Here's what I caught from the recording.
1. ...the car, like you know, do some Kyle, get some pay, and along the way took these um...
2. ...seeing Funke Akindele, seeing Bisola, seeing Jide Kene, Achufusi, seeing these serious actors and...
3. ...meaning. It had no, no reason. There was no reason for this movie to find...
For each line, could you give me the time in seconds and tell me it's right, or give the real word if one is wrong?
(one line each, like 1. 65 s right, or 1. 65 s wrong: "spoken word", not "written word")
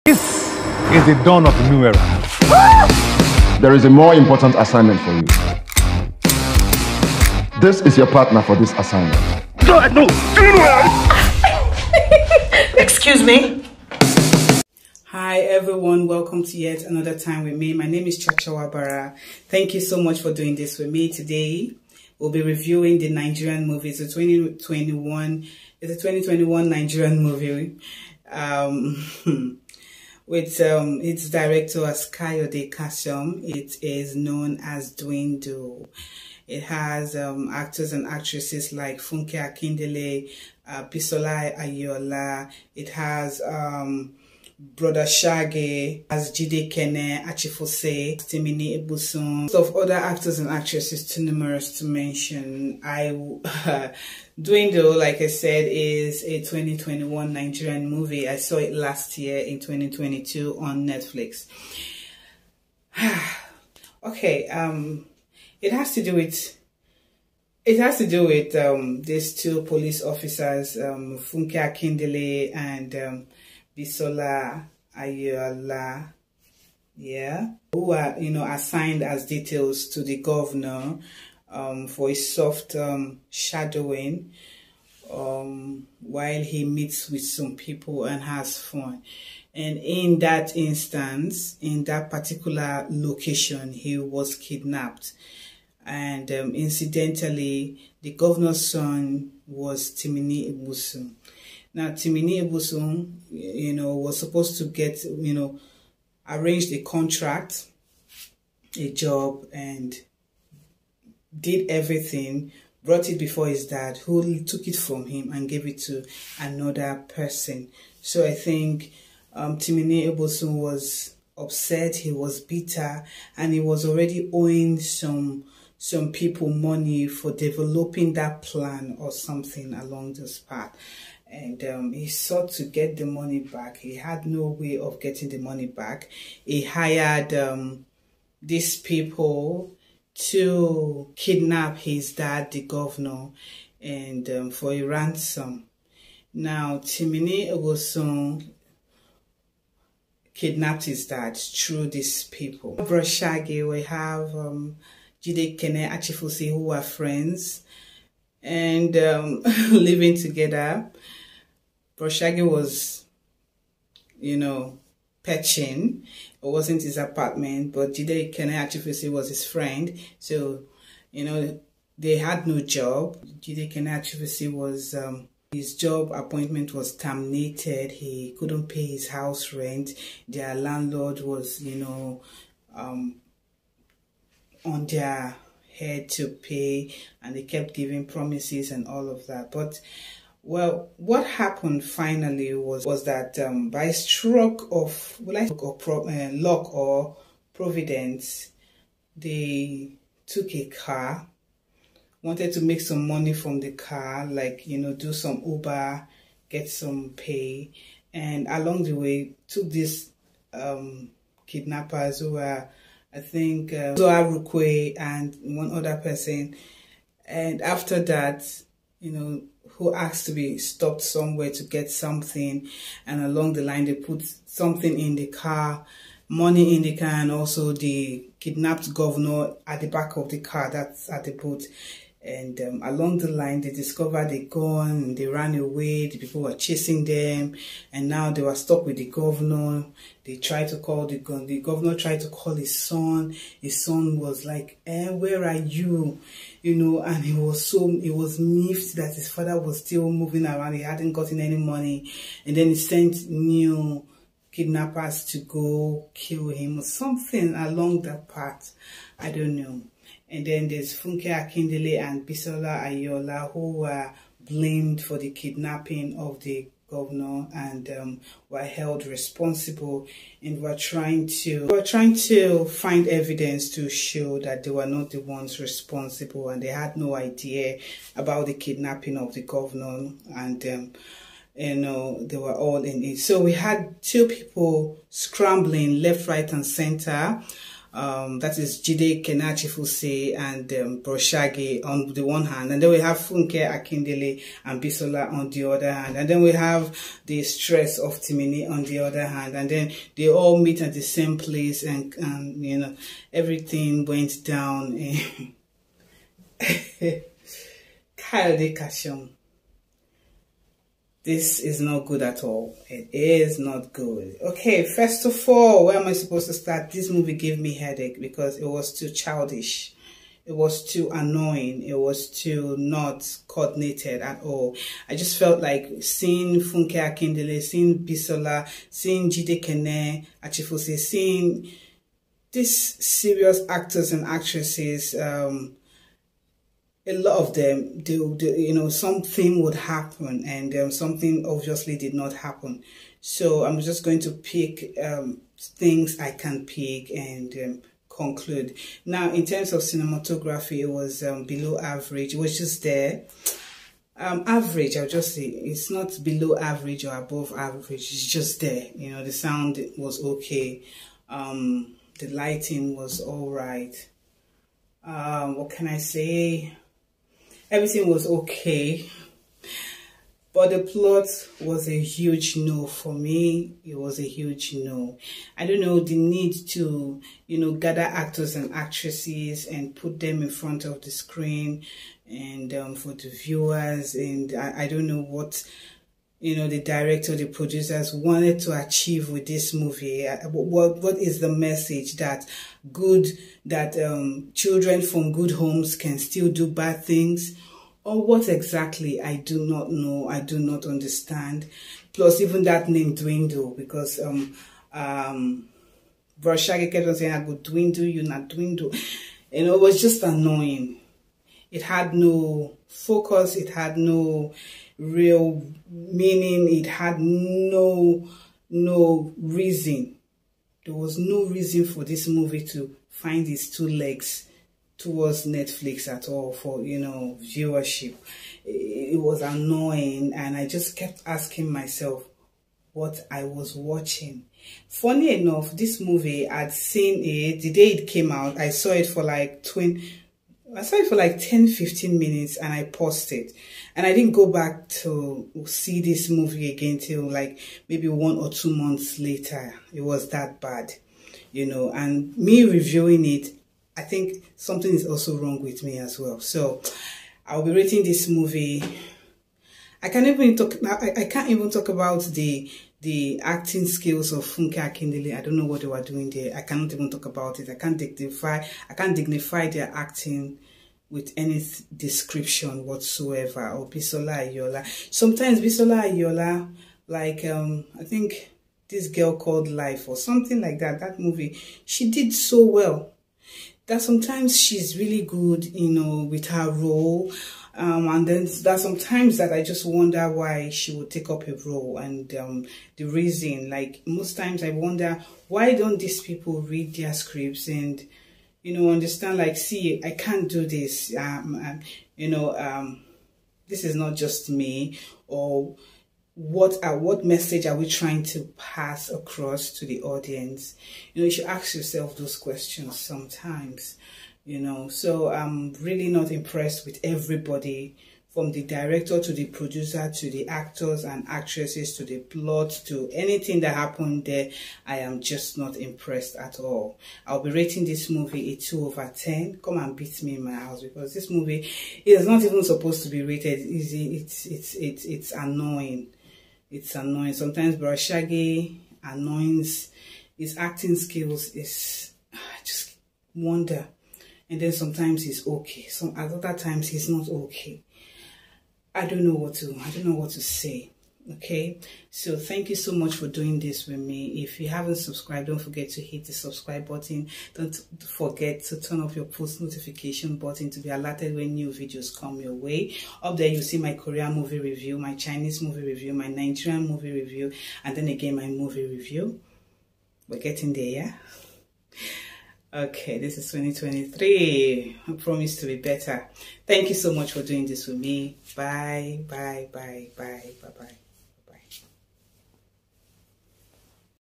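1. 203 s wrong: "Uber", not "Kyle"
2. 326 s right
3. 415 s right.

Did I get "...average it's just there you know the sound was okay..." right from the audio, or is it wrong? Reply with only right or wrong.
right.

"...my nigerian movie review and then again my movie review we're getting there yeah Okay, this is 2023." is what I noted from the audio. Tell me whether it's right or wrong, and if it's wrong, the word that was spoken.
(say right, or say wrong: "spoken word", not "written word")
right.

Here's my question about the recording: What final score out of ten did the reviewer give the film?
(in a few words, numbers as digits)
2.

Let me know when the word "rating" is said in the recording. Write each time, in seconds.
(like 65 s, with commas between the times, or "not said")
457 s, 527 s.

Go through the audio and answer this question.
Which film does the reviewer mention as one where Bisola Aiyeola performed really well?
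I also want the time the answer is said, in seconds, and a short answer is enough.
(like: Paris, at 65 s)
Life, at 479 s.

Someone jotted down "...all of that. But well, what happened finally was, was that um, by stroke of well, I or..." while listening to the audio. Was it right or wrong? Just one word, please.
right.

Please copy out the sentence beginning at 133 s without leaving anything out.
He had no way of getting the money back.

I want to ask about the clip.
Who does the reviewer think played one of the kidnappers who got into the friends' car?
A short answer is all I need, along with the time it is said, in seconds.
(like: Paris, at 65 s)
Uzor Arukwe, at 213 s.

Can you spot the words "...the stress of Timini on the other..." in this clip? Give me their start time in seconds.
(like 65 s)
297 s.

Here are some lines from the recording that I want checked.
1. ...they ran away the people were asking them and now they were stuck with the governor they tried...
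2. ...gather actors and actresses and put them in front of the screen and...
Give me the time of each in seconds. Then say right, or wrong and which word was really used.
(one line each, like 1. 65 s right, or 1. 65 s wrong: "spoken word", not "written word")
1. 235 s wrong: "chasing", not "asking"
2. 377 s right.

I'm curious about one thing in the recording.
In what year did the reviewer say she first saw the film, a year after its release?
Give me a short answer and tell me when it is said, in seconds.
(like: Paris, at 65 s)
2022, at 59 s.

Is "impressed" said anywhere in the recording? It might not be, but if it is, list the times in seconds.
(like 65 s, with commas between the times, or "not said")
516 s, 525 s.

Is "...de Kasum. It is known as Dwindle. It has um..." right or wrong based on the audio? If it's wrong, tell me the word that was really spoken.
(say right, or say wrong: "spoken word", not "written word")
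right.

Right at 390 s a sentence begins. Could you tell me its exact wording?
Uh, what, what is the message that good, that um, children from good homes can still do bad things?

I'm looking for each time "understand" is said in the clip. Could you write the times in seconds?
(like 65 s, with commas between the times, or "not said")
400 s, 498 s.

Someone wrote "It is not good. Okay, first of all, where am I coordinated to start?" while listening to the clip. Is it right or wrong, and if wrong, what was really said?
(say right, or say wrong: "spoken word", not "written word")
wrong: "supposed", not "coordinated".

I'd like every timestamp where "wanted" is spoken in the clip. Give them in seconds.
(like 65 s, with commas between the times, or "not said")
202 s, 388 s.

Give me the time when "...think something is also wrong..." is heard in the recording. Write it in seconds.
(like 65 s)
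454 s.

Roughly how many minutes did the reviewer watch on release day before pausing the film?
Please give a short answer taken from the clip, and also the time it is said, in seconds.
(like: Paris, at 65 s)
10 to 15 minutes, at 441 s.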